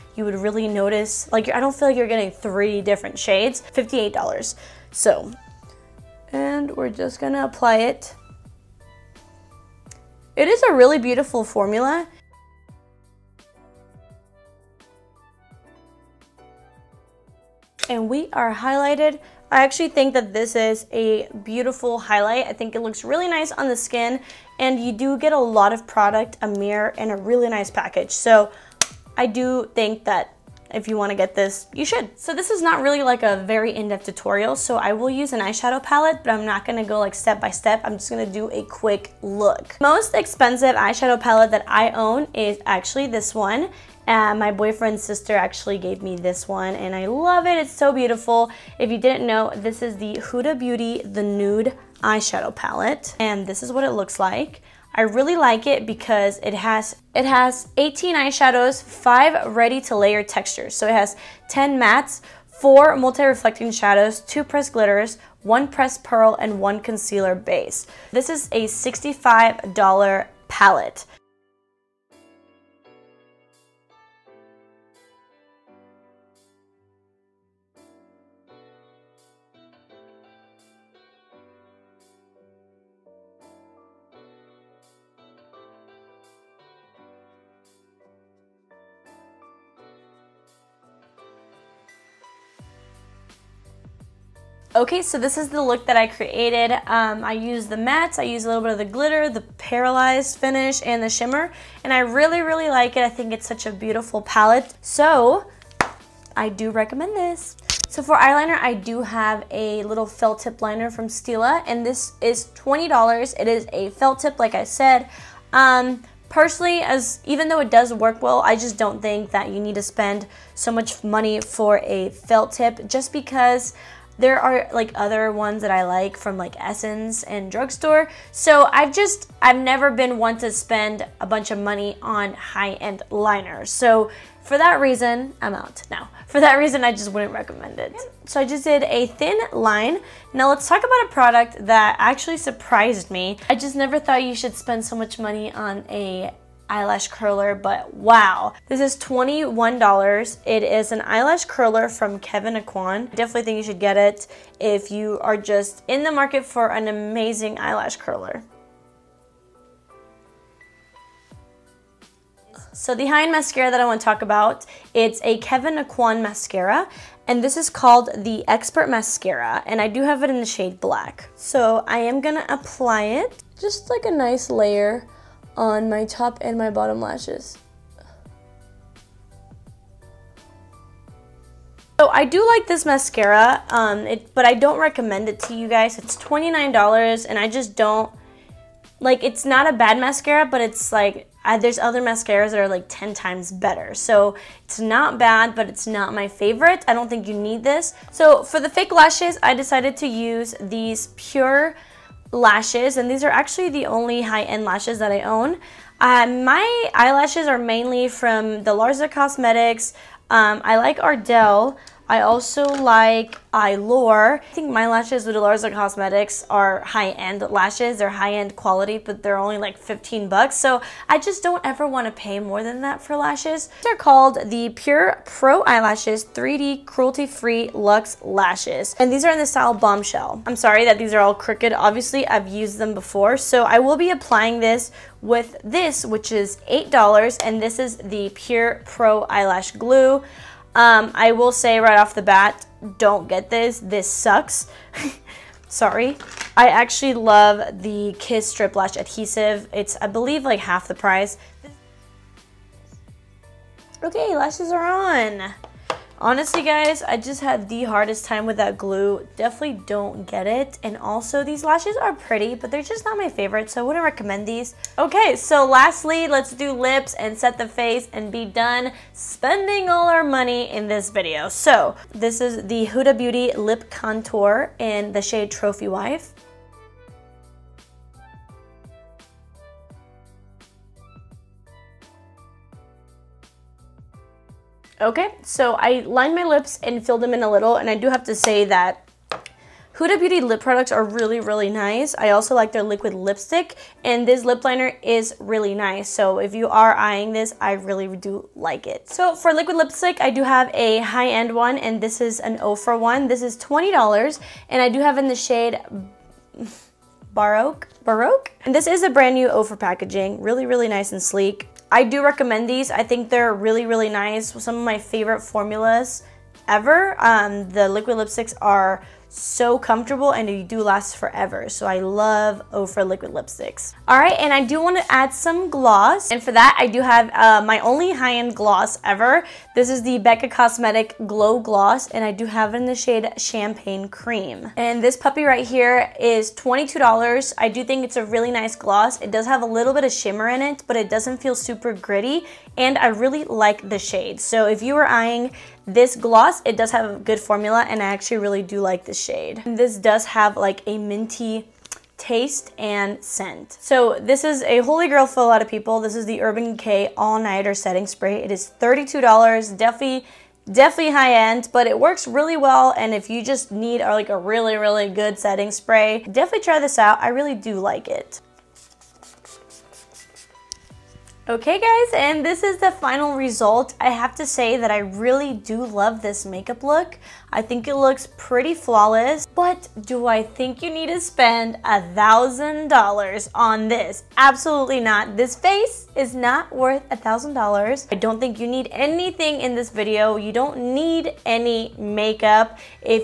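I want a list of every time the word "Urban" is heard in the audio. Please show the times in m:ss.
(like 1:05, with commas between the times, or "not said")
5:56.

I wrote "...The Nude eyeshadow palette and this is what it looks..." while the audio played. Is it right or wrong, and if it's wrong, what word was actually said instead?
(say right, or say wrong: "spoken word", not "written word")
right.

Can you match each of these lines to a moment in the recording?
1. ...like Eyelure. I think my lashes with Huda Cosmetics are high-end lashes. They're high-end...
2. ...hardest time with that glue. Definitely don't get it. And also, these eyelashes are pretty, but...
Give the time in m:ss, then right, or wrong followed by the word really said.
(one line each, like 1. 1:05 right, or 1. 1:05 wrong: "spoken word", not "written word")
1. 3:32 wrong: "Delarza", not "Huda"
2. 4:17 wrong: "lashes", not "eyelashes".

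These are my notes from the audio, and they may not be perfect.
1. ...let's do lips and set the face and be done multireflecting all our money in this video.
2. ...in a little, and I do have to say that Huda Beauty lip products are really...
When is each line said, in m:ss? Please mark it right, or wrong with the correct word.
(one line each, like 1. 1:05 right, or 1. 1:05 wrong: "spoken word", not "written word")
1. 4:26 wrong: "spending", not "multireflecting"
2. 4:47 right.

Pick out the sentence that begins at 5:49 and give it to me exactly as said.
This does have like a minty taste and scent.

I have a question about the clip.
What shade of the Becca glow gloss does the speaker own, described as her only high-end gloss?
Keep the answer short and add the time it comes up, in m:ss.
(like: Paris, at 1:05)
Champagne Cream, at 5:33.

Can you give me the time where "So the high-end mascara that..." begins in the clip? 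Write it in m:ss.
2:42.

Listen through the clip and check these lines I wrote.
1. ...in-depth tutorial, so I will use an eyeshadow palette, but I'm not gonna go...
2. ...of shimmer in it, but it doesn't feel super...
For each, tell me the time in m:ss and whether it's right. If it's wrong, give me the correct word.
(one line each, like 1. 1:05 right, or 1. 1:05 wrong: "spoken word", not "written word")
1. 0:33 right
2. 5:40 right.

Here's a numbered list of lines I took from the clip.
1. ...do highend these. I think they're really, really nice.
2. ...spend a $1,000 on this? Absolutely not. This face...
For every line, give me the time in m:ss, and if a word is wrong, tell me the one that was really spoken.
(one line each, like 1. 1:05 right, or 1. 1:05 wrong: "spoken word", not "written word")
1. 5:12 wrong: "recommend", not "highend"
2. 6:21 right.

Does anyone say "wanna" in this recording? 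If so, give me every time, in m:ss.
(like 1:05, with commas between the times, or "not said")
0:30, 5:24.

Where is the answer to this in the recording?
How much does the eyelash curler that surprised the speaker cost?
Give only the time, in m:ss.
2:28.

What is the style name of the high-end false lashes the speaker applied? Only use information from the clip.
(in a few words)
Bombshell.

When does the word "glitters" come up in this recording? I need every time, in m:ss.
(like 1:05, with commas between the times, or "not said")
1:04, 1:38.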